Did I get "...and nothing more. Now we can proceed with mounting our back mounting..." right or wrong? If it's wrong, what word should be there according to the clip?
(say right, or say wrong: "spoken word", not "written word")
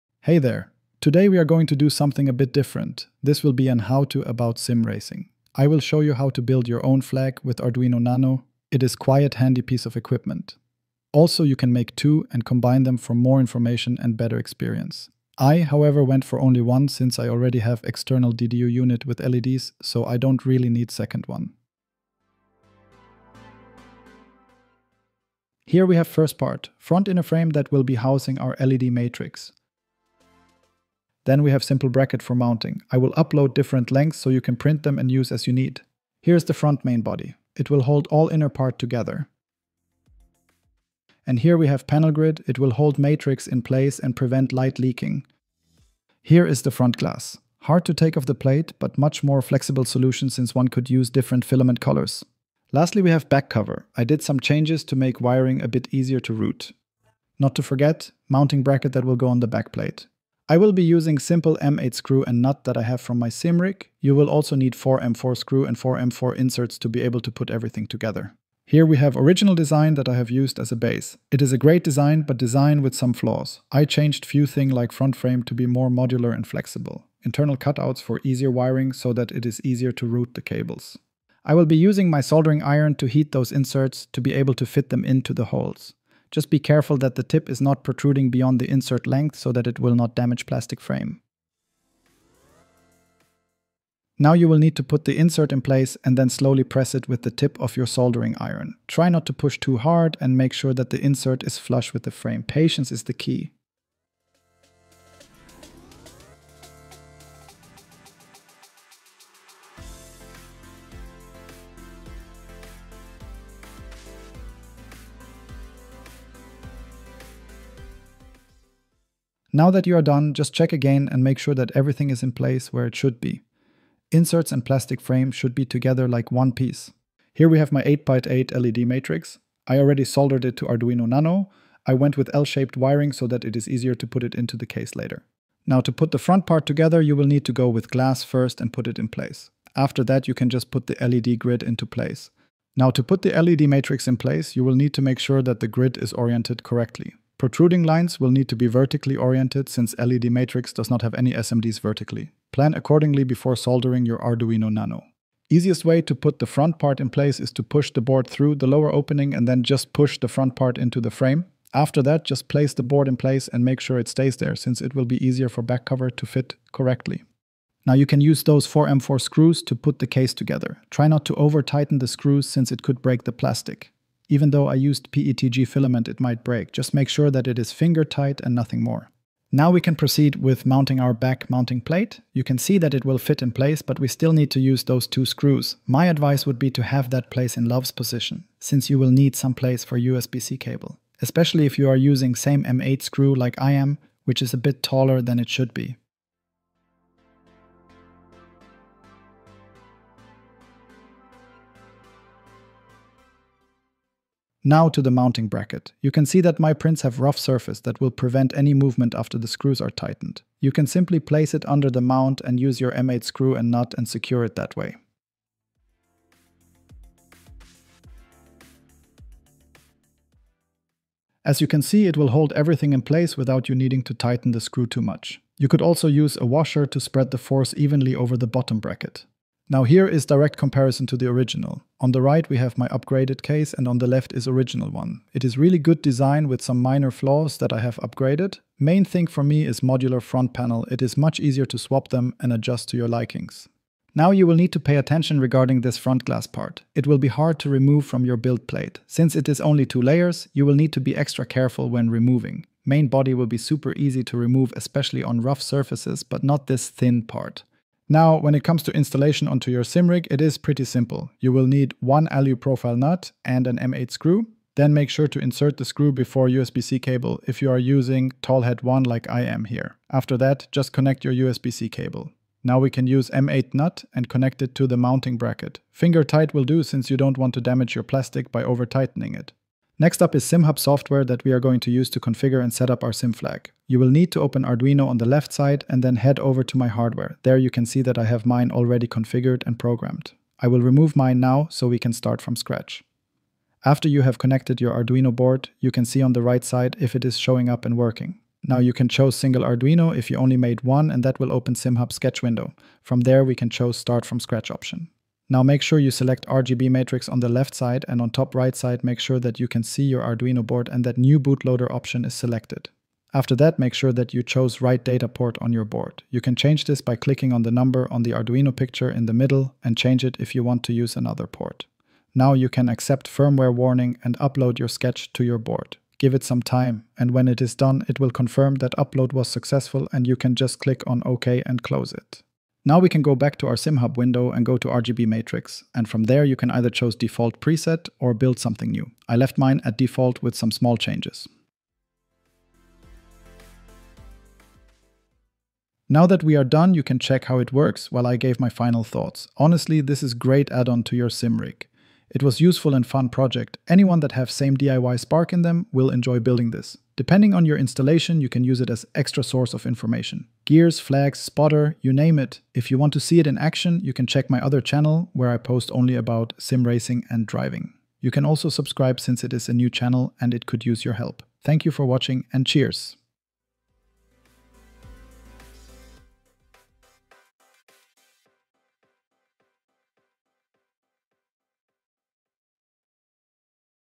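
right.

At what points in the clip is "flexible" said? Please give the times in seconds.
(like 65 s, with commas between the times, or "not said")
49 s, 76 s.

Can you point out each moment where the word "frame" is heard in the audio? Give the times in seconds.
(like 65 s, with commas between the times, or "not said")
27 s, 75 s, 90 s, 102 s, 125 s, 161 s.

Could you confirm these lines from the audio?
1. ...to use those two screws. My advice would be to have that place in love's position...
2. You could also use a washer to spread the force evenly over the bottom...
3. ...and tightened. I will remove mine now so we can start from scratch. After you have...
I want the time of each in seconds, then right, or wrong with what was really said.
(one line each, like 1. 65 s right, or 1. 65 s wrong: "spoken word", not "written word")
1. 184 s right
2. 225 s right
3. 289 s wrong: "programmed", not "tightened".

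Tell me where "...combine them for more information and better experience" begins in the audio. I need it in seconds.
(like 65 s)
12 s.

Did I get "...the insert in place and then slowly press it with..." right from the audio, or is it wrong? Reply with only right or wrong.
right.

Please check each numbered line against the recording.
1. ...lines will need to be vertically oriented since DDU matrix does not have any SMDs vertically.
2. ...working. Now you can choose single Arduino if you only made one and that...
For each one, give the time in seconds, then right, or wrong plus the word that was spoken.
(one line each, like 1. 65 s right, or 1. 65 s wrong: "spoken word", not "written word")
1. 147 s wrong: "LED", not "DDU"
2. 297 s right.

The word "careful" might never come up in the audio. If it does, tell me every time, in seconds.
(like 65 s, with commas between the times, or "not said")
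86 s, 251 s.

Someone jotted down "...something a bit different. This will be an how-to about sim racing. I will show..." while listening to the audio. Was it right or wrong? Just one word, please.
right.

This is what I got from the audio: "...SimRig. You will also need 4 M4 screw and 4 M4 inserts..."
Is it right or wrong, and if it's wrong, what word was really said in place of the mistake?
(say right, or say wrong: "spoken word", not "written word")
right.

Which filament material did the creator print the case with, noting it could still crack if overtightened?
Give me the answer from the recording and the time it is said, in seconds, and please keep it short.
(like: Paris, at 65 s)
PETG, at 175 s.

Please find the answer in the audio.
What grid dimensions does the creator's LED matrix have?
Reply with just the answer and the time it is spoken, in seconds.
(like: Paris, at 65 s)
8x8, at 127 s.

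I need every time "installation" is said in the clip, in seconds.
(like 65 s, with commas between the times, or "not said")
258 s, 357 s.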